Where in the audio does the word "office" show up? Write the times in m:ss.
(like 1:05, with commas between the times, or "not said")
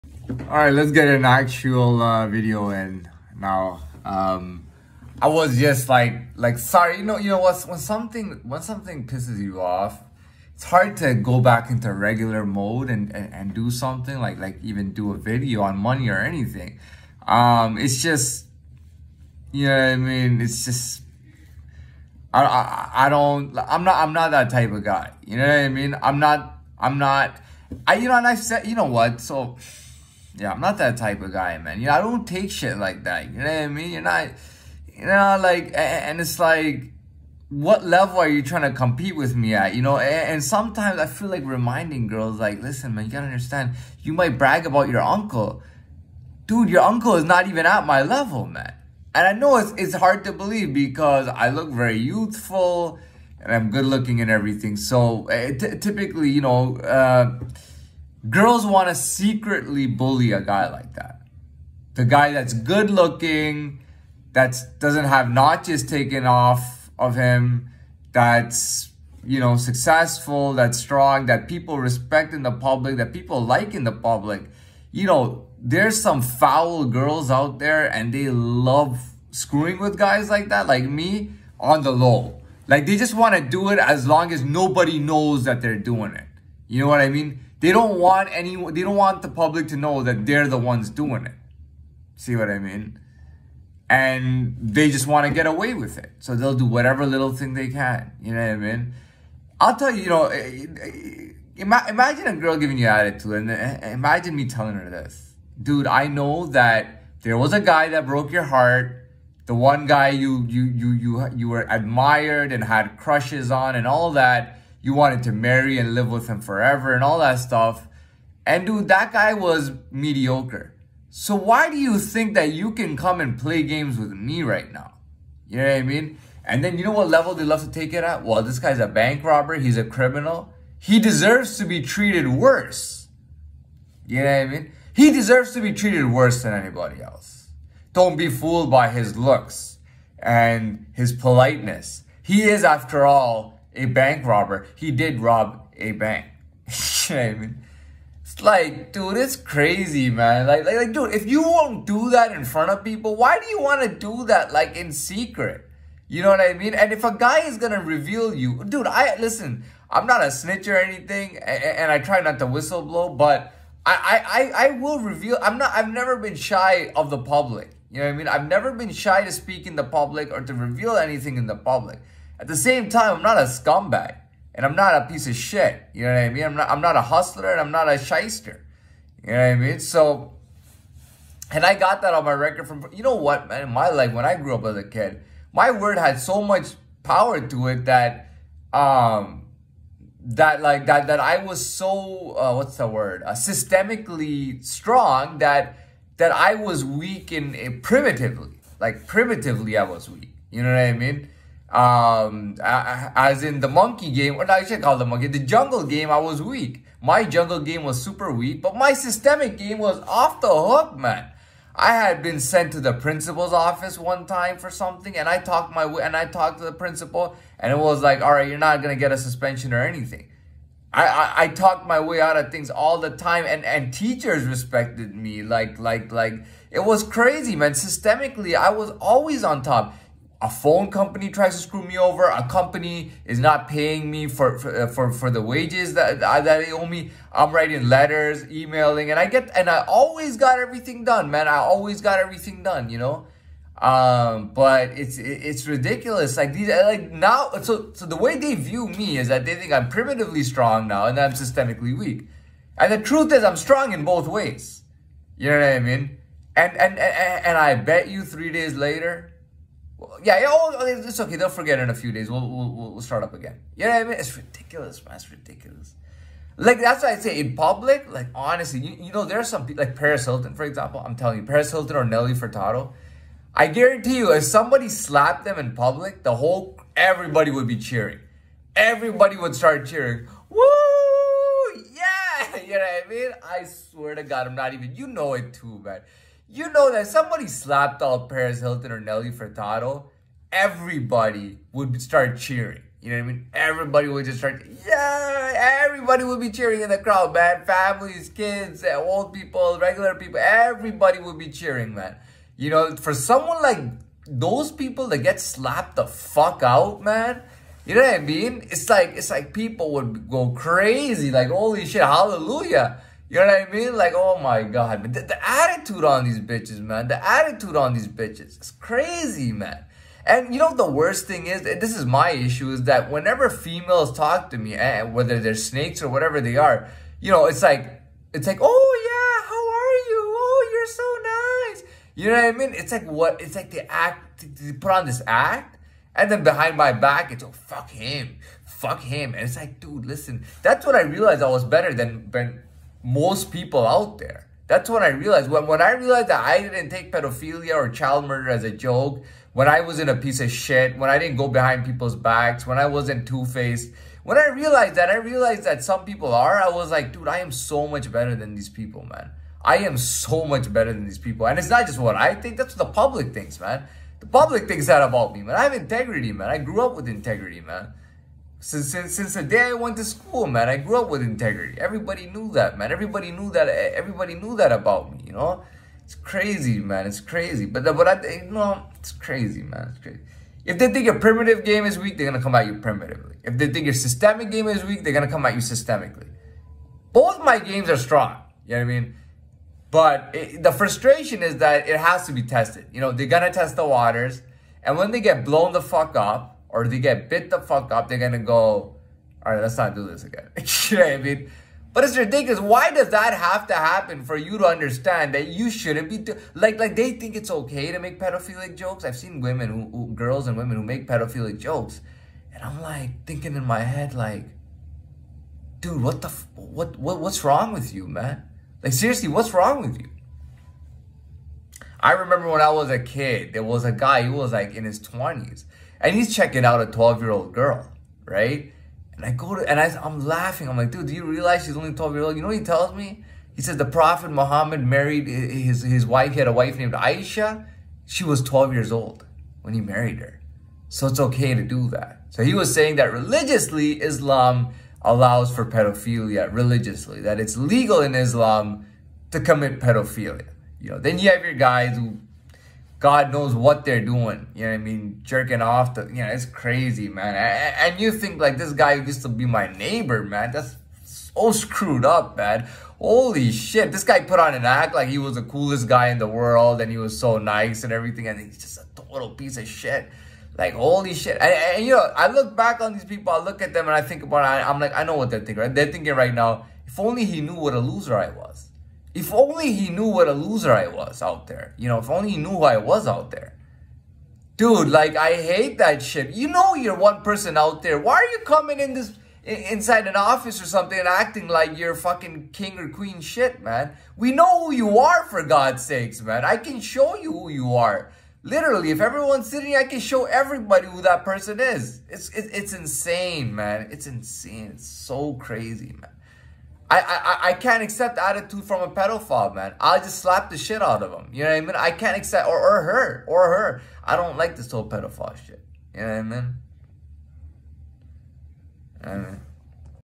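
3:33, 8:10.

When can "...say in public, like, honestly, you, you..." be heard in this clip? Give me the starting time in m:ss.
4:27.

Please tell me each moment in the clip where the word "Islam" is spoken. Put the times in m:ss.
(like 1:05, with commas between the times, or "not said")
7:24, 7:28.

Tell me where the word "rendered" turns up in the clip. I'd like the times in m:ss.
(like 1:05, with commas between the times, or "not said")
not said.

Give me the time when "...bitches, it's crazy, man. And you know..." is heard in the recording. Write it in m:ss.
5:18.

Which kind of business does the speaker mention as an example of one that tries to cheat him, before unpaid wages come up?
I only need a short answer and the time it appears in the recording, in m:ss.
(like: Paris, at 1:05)
phone company, at 3:50.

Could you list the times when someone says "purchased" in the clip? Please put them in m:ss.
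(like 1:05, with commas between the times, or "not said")
not said.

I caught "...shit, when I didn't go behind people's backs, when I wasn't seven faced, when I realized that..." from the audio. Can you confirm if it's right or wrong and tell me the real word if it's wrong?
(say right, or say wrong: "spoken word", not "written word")
wrong: "two", not "seven".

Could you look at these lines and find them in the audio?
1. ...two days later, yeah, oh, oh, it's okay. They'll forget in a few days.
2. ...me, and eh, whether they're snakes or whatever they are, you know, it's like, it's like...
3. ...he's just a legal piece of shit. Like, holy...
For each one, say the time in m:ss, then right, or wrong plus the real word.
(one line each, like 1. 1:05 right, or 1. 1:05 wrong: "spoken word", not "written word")
1. 4:18 wrong: "three", not "two"
2. 5:24 right
3. 7:48 wrong: "total", not "legal".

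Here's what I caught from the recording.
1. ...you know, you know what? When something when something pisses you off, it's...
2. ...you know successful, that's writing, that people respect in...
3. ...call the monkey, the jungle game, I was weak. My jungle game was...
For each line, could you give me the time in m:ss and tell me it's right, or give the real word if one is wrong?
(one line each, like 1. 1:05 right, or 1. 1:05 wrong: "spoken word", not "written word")
1. 0:06 right
2. 1:09 wrong: "strong", not "writing"
3. 3:24 right.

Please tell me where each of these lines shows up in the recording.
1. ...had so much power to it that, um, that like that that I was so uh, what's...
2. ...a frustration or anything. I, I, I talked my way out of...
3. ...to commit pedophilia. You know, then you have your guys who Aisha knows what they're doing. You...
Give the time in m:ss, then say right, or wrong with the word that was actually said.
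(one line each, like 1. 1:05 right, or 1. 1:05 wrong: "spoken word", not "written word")
1. 3:05 right
2. 3:39 wrong: "suspension", not "frustration"
3. 7:29 wrong: "God", not "Aisha".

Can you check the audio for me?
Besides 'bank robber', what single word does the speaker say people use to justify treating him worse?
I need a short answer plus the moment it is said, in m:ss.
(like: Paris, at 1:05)
criminal, at 2:09.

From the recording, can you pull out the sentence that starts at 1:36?
So they'll do whatever little thing they can.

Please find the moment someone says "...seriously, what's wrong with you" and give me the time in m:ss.
6:58.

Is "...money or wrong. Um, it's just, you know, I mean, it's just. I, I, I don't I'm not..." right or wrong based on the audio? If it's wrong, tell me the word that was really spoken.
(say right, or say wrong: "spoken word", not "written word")
wrong: "anything", not "wrong".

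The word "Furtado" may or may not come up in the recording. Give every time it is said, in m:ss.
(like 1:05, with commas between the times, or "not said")
4:32, 4:49.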